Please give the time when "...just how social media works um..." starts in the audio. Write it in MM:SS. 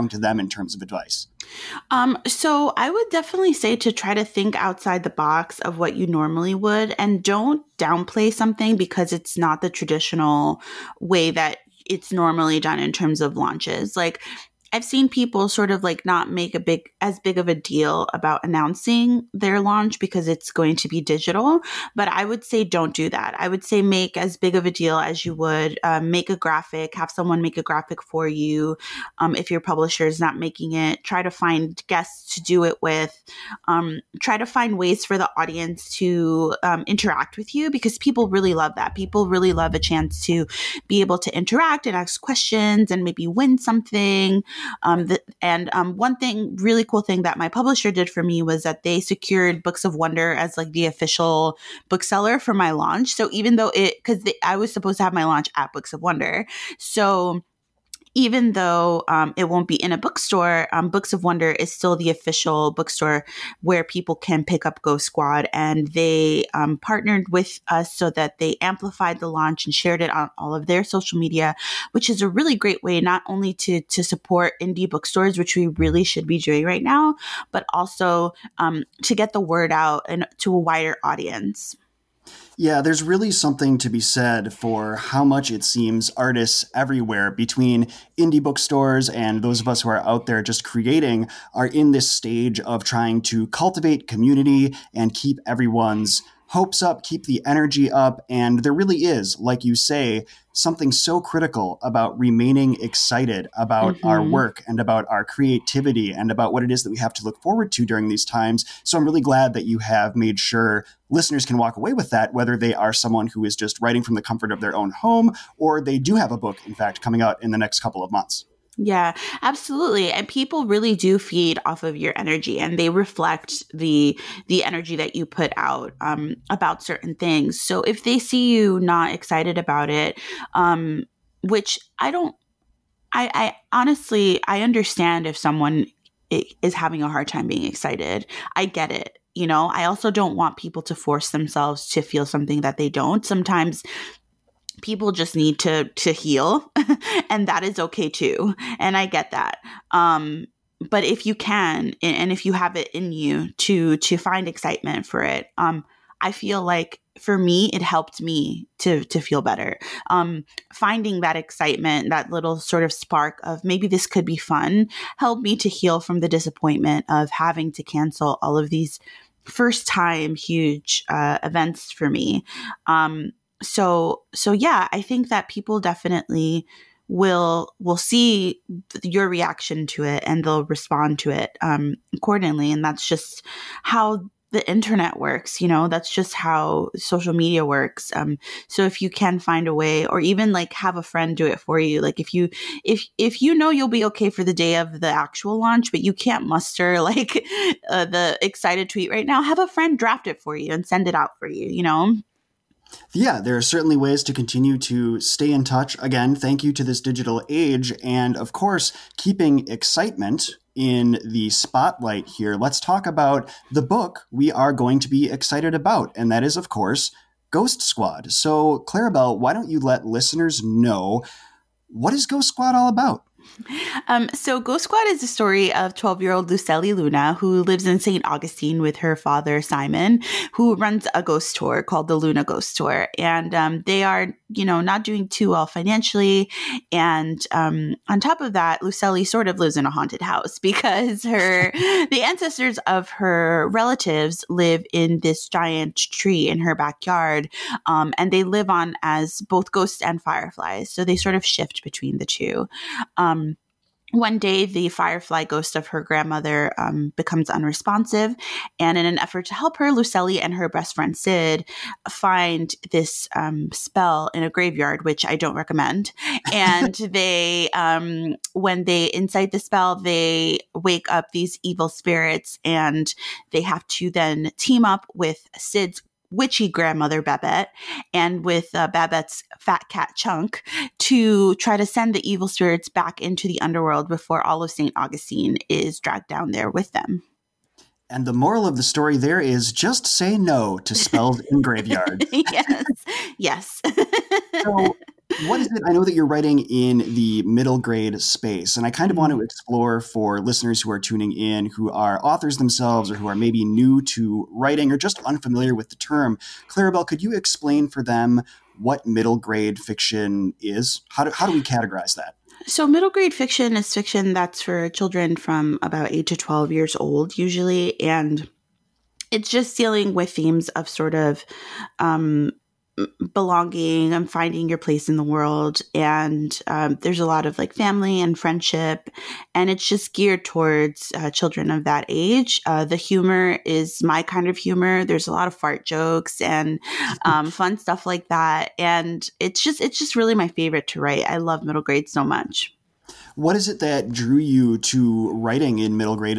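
03:06.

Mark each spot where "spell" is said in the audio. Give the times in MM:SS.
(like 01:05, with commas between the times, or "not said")
04:23, 04:29, 04:50.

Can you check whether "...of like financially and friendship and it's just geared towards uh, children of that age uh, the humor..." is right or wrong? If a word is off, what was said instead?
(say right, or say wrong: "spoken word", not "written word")
wrong: "family", not "financially".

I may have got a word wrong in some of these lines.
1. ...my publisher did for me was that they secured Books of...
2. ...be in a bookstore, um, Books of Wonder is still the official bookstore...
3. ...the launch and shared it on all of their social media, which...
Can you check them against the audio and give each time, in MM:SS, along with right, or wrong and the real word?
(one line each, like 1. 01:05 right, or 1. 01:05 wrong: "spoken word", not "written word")
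1. 00:47 right
2. 00:59 right
3. 01:09 right.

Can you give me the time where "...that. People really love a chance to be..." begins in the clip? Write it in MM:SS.
00:38.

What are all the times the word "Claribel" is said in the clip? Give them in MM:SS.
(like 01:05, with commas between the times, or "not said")
03:38, 05:06.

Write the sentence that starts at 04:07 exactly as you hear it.
Um, and they live on as both ghosts and fireflies.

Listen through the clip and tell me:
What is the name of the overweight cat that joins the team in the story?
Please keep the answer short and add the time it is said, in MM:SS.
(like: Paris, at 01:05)
Chunk, at 04:40.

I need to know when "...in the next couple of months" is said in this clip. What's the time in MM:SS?
01:57.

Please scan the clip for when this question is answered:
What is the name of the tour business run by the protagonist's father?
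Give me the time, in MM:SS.
03:52.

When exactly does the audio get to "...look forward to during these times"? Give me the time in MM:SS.
01:47.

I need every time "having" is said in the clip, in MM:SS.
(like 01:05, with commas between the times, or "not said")
02:16, 02:47.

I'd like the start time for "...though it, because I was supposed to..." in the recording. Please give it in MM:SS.
00:53.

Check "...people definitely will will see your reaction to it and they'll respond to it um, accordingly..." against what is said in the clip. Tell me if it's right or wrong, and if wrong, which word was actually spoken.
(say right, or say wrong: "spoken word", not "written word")
right.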